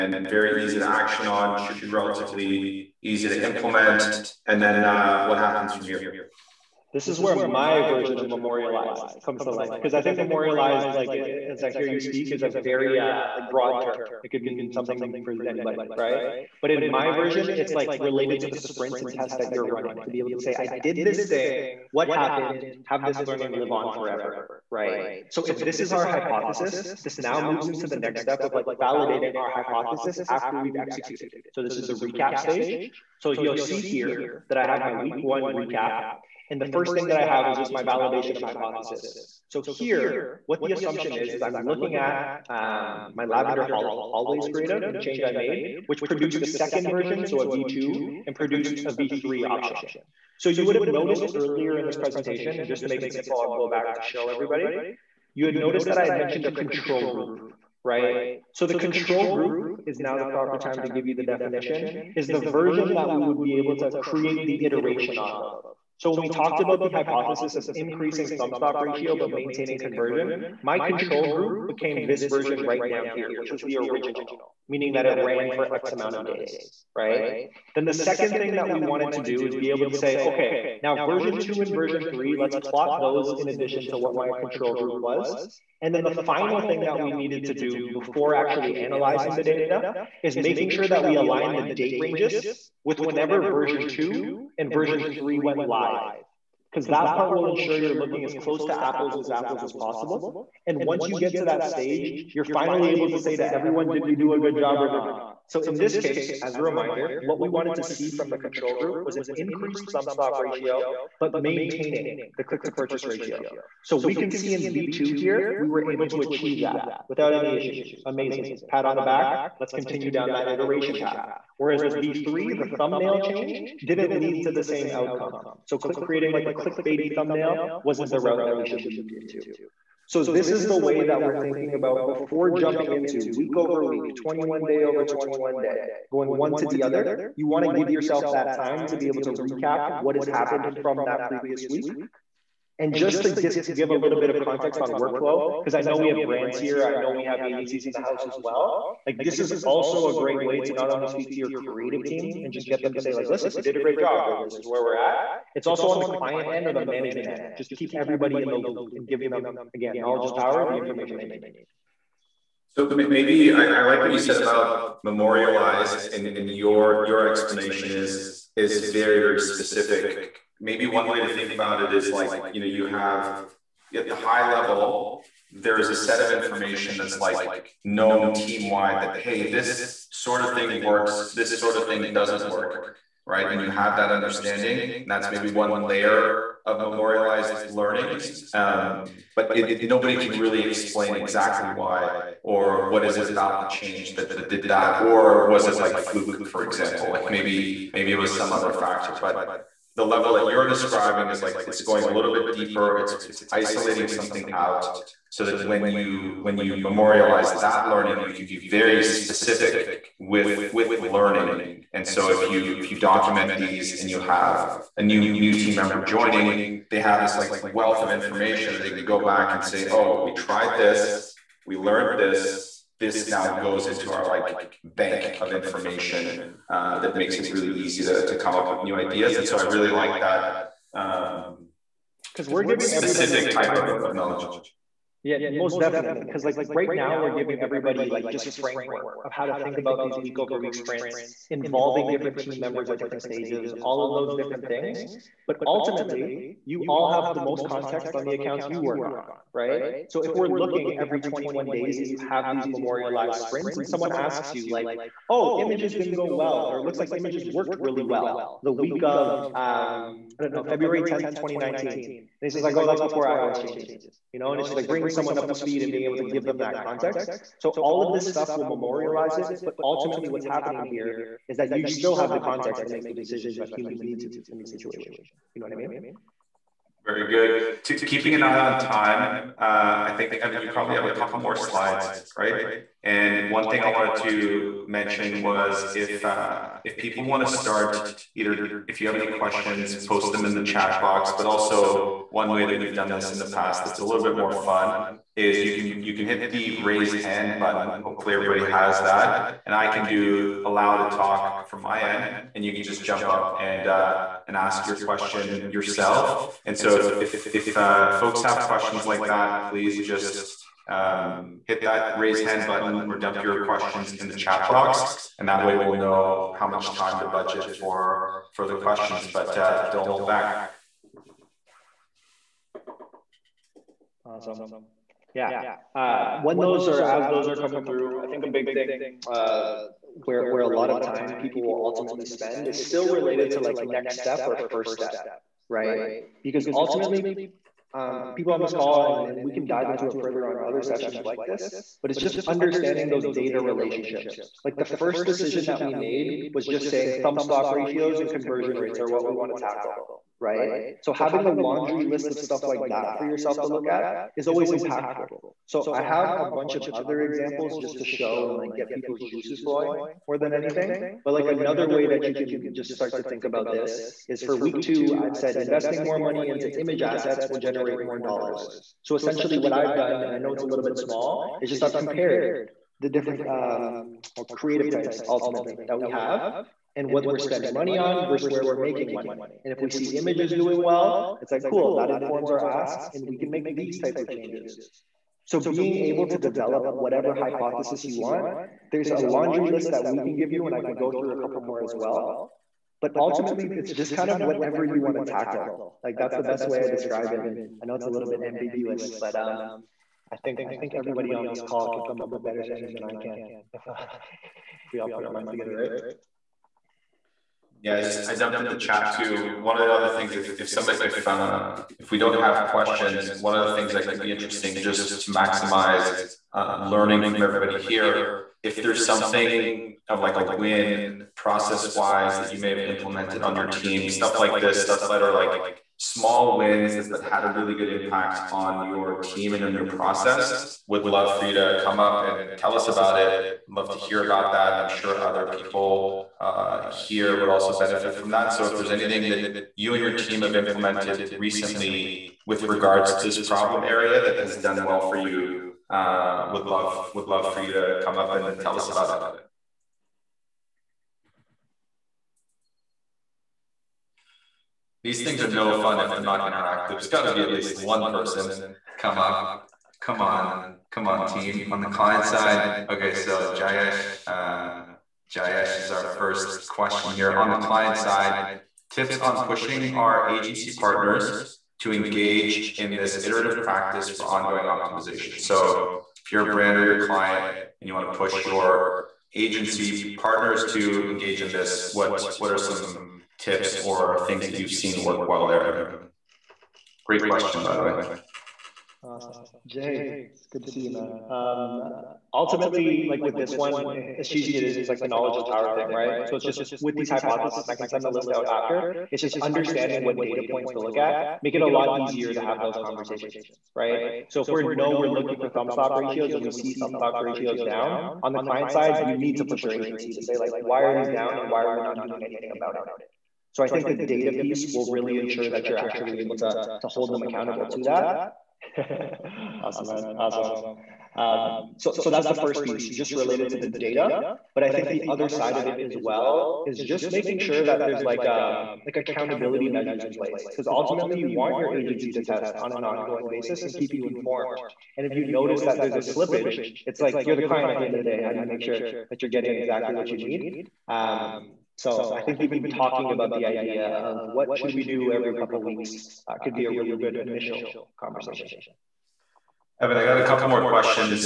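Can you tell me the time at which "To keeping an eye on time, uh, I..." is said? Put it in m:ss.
4:37.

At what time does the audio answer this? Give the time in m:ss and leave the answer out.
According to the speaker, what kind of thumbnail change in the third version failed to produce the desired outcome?
2:06.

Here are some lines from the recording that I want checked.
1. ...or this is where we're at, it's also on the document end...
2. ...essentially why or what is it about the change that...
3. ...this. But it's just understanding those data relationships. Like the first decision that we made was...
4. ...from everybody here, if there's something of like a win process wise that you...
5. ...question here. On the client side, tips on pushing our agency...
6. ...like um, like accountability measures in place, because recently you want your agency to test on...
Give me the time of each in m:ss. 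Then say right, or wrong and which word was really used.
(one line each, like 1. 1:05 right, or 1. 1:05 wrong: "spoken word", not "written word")
1. 2:34 wrong: "client", not "document"
2. 3:11 wrong: "exactly", not "essentially"
3. 5:41 right
4. 6:57 right
5. 7:46 right
6. 8:48 wrong: "ultimately", not "recently".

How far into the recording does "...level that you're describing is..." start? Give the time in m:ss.
3:20.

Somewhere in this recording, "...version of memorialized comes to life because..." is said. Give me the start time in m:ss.
0:07.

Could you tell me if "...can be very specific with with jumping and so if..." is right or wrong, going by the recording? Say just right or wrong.
wrong.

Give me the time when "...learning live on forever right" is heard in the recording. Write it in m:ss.
0:23.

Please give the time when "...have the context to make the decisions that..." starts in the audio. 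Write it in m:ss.
4:32.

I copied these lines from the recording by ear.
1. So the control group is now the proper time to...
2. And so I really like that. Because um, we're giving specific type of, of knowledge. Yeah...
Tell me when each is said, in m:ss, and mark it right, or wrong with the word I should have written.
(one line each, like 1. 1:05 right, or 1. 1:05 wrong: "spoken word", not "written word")
1. 0:58 right
2. 3:49 right.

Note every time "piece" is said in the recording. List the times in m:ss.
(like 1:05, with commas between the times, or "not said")
8:34, 8:42.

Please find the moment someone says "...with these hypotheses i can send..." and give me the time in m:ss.
8:16.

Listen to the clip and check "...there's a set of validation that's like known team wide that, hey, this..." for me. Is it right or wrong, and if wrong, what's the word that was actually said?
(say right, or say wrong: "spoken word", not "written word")
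wrong: "information", not "validation".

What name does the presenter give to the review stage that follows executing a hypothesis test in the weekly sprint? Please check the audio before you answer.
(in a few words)
Recap stage.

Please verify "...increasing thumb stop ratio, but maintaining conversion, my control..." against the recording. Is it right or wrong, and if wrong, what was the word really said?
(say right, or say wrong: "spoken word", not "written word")
right.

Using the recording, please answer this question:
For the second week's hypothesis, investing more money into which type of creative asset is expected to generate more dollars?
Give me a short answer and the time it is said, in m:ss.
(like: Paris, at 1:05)
Image assets, at 6:06.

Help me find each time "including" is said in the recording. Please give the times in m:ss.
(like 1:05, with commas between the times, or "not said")
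not said.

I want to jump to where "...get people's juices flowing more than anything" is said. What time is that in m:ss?
5:58.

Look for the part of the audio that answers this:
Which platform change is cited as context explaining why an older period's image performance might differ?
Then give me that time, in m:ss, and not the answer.
4:23.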